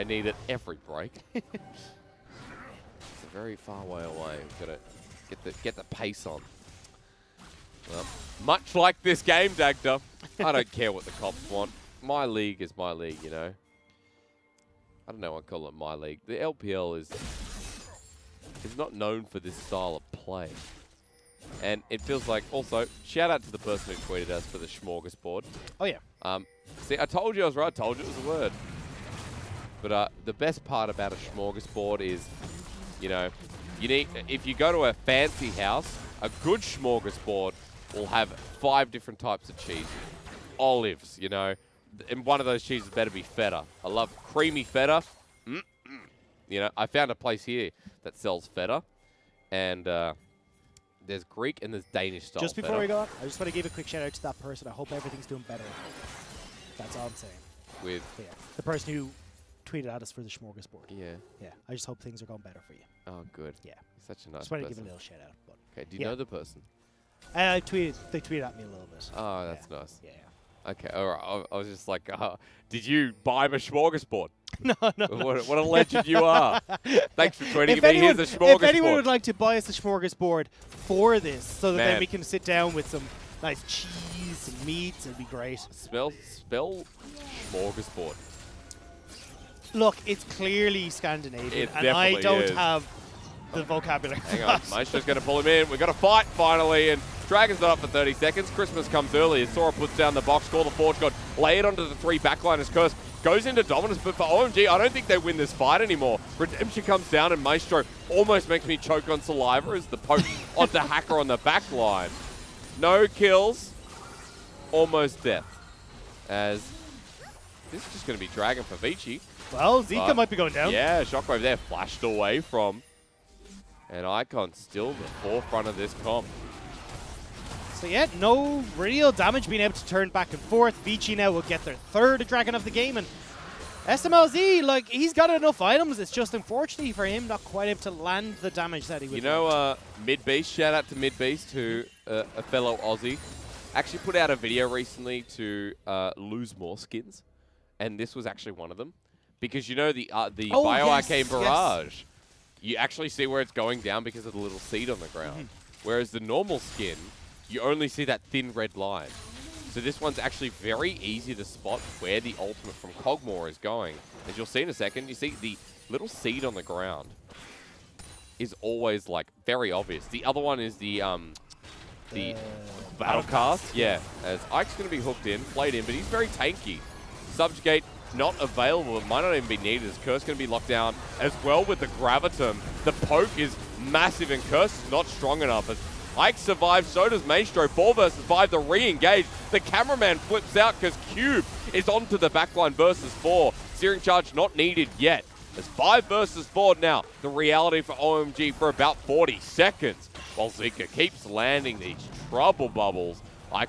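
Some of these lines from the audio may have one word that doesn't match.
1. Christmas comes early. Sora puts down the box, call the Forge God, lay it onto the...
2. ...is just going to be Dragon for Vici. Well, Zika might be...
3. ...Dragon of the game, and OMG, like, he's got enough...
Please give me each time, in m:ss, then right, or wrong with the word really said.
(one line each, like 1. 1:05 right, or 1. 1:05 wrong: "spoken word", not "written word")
1. 1:38 right
2. 1:57 right
3. 2:12 wrong: "SMLZ", not "OMG".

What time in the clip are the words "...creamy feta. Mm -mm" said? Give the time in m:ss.
0:44.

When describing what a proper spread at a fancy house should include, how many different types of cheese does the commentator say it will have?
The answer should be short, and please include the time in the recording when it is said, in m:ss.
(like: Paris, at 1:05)
5, at 0:38.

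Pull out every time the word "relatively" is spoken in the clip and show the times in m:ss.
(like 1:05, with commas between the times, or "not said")
not said.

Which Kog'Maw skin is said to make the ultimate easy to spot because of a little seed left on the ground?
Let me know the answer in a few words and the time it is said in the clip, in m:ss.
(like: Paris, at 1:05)
Bioarcane, at 2:30.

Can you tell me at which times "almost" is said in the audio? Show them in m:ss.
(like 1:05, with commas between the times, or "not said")
1:48, 1:54.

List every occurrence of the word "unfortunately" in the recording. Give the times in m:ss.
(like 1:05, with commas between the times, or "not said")
2:16.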